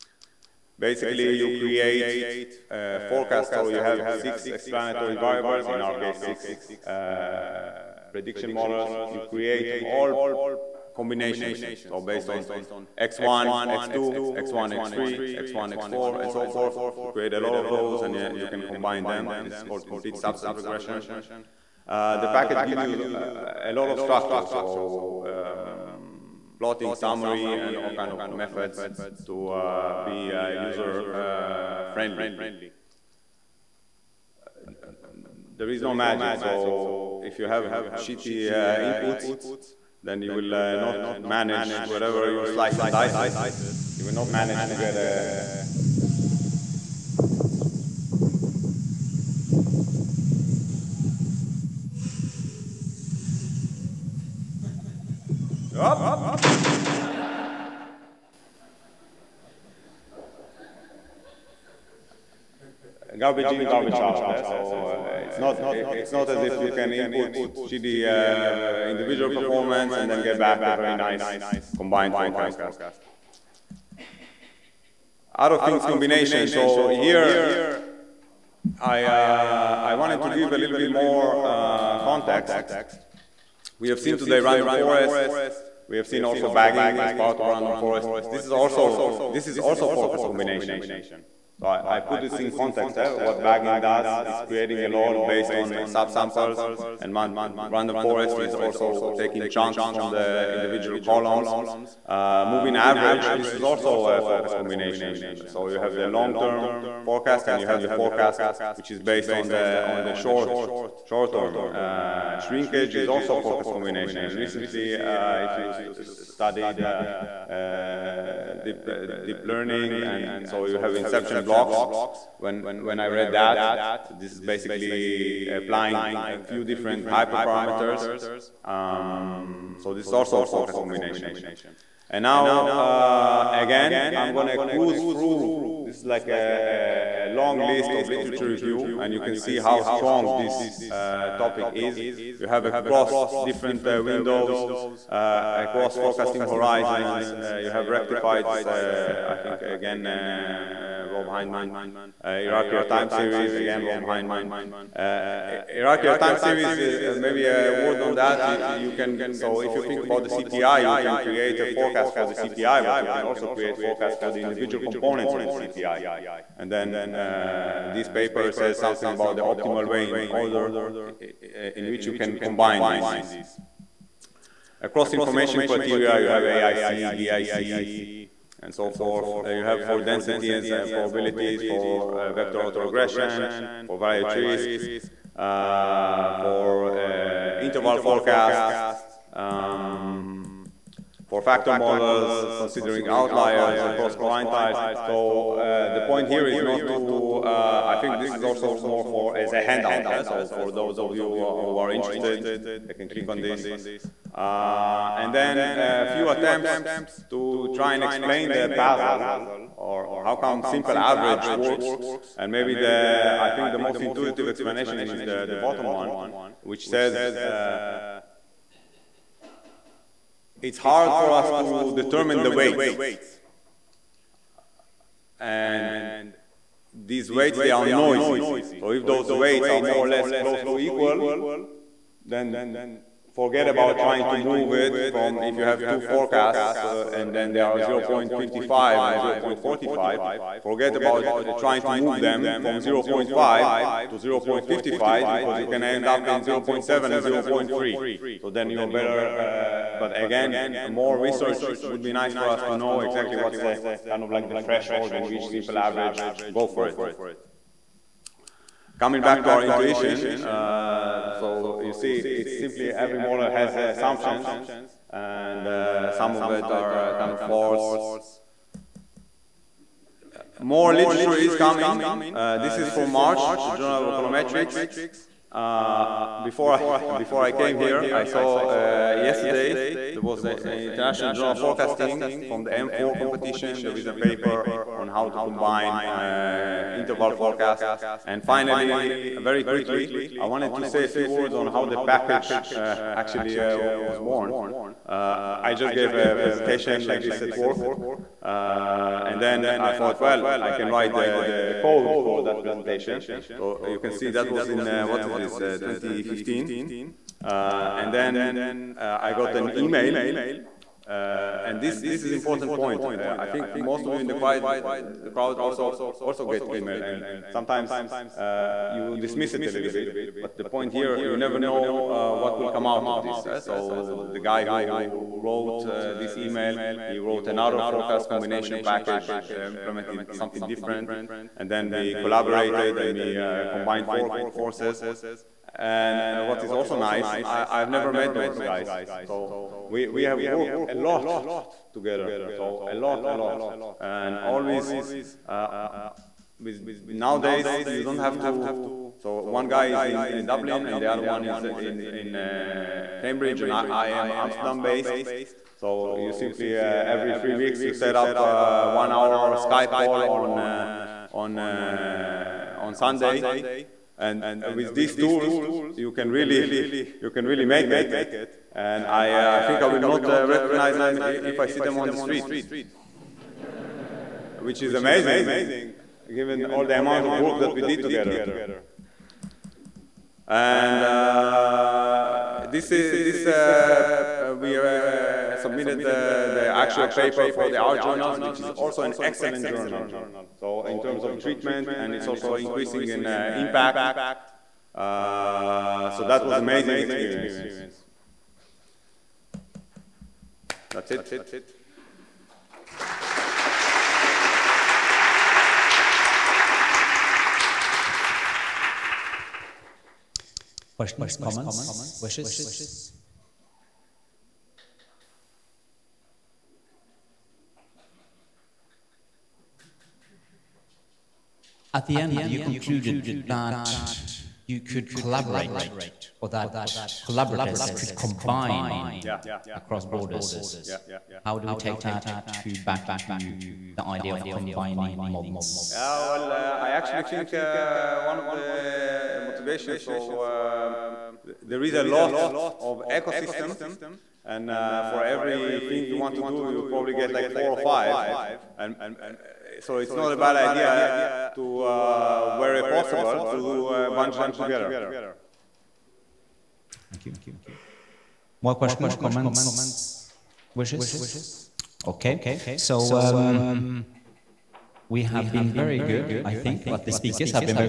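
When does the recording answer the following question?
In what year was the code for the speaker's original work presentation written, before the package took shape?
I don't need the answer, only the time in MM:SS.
05:05.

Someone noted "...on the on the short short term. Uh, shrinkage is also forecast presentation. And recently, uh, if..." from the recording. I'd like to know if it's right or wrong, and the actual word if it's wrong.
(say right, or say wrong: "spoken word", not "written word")
wrong: "combination", not "presentation".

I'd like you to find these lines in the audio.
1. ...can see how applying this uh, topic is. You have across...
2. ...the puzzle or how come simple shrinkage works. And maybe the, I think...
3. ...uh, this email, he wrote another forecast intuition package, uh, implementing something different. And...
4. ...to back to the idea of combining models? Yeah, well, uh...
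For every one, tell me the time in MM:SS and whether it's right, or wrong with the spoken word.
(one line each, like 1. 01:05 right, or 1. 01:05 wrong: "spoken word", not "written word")
1. 02:19 wrong: "strong", not "applying"
2. 03:28 wrong: "average", not "shrinkage"
3. 05:25 wrong: "combination", not "intuition"
4. 07:12 right.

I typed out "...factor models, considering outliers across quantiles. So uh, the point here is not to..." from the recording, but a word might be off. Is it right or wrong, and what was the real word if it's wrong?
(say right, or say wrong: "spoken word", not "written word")
right.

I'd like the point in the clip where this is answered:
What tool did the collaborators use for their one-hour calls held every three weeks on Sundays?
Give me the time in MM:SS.
05:59.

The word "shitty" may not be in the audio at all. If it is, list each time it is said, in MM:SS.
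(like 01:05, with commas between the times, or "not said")
00:37, 01:07.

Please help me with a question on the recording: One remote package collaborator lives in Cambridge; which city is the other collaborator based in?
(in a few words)
Dublin.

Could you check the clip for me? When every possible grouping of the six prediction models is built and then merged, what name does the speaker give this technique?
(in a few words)
complete subset regression.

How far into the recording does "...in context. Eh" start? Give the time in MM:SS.
01:32.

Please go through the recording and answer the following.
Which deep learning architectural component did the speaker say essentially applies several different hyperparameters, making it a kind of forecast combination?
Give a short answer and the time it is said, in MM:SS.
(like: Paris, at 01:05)
inception blocks, at 02:00.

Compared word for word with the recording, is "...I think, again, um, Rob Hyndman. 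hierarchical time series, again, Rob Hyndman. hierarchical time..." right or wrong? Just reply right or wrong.
right.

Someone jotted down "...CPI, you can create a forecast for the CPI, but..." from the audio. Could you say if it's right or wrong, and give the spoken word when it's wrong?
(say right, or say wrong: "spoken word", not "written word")
right.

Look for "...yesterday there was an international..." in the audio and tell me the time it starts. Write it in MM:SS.
04:39.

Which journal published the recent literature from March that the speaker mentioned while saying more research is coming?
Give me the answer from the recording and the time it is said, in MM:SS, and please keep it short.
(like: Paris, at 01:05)
Journal of Econometrics, at 04:33.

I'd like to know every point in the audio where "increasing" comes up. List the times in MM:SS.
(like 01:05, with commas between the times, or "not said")
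06:32.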